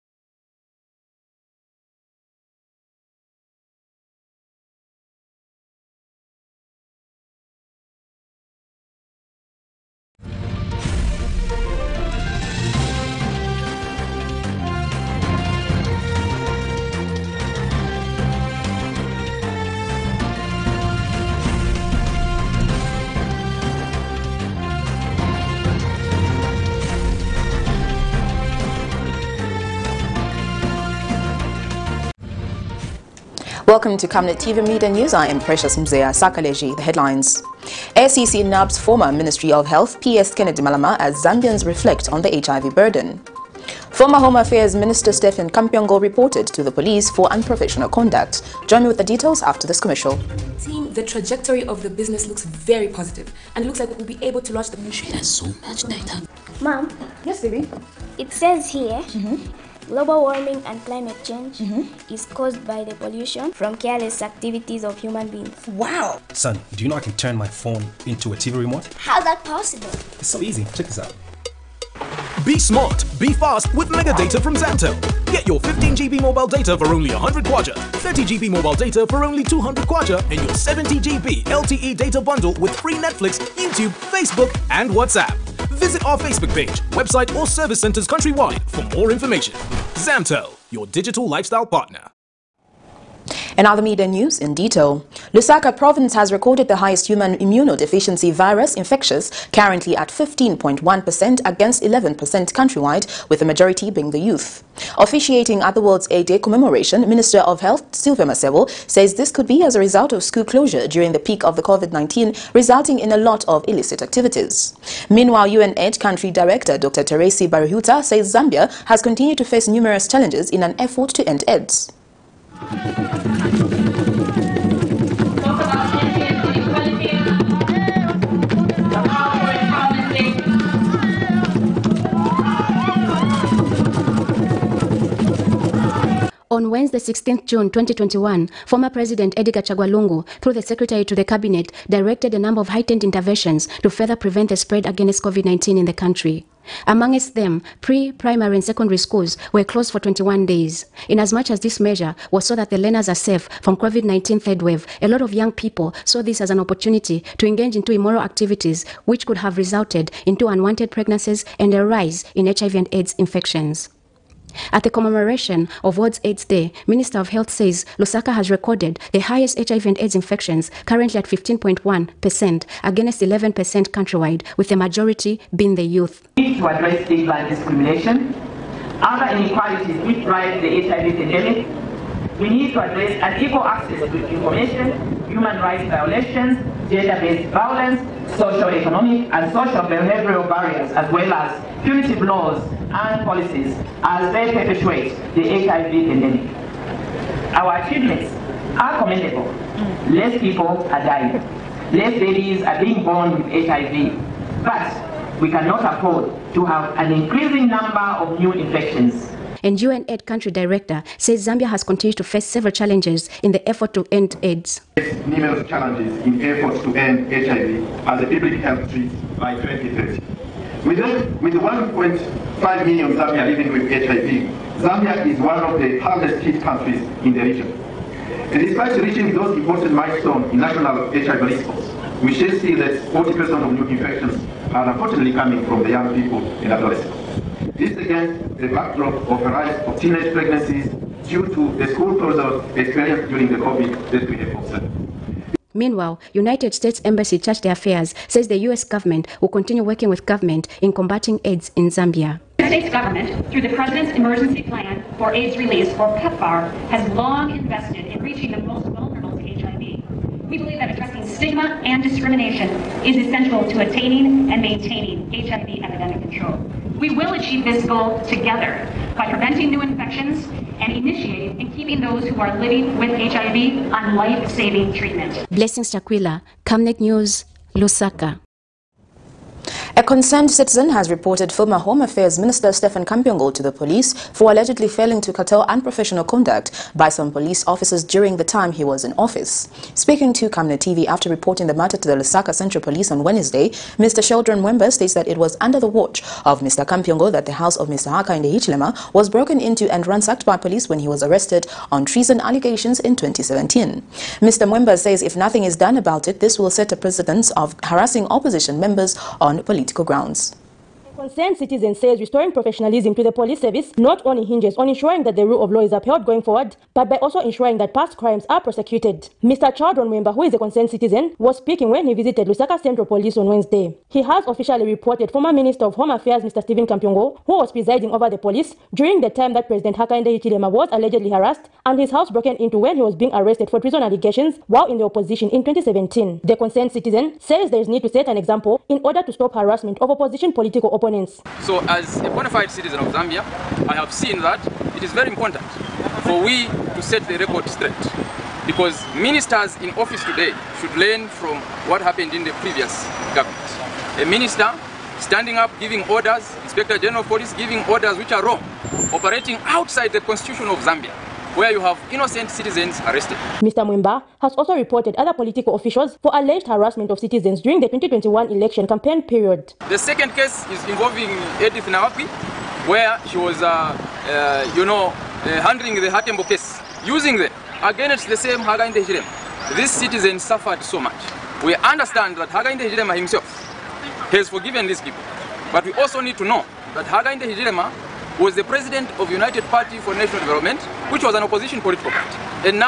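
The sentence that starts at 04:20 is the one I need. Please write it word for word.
We believe that addressing stigma and discrimination is essential to attaining and maintaining HIV epidemic control.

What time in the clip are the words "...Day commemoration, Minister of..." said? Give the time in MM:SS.
01:46.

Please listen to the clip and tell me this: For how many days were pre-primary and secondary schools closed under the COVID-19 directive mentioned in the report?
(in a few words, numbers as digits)
21.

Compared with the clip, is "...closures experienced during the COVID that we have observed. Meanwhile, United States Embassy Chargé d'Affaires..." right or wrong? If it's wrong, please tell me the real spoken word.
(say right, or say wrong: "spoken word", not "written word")
right.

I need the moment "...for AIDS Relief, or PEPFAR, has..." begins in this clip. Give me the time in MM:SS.
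04:15.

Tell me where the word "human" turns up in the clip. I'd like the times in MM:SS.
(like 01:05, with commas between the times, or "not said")
01:05, 01:37, 03:05.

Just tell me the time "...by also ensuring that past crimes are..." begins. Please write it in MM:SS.
05:17.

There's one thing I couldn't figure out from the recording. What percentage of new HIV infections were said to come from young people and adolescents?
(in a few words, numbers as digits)
40%.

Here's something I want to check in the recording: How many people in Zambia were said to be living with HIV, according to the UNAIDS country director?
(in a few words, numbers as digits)
1.5 million.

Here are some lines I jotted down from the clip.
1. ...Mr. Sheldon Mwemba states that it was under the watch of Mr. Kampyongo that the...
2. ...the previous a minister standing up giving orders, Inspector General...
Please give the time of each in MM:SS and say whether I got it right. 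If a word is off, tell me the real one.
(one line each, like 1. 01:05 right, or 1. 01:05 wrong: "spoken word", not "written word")
1. 04:53 right
2. 05:52 right.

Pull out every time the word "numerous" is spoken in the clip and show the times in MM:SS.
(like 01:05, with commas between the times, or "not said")
01:59, 03:35.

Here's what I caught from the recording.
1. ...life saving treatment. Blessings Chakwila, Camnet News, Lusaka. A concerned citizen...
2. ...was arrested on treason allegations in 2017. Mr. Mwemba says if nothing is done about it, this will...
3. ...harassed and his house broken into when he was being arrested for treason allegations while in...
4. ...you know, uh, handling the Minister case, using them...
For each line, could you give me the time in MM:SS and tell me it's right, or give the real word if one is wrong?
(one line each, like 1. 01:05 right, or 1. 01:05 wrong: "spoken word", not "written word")
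1. 04:34 right
2. 05:01 right
3. 05:31 right
4. 06:14 wrong: "Hatembo", not "Minister".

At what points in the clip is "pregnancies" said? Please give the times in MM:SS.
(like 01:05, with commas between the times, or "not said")
02:40, 04:00.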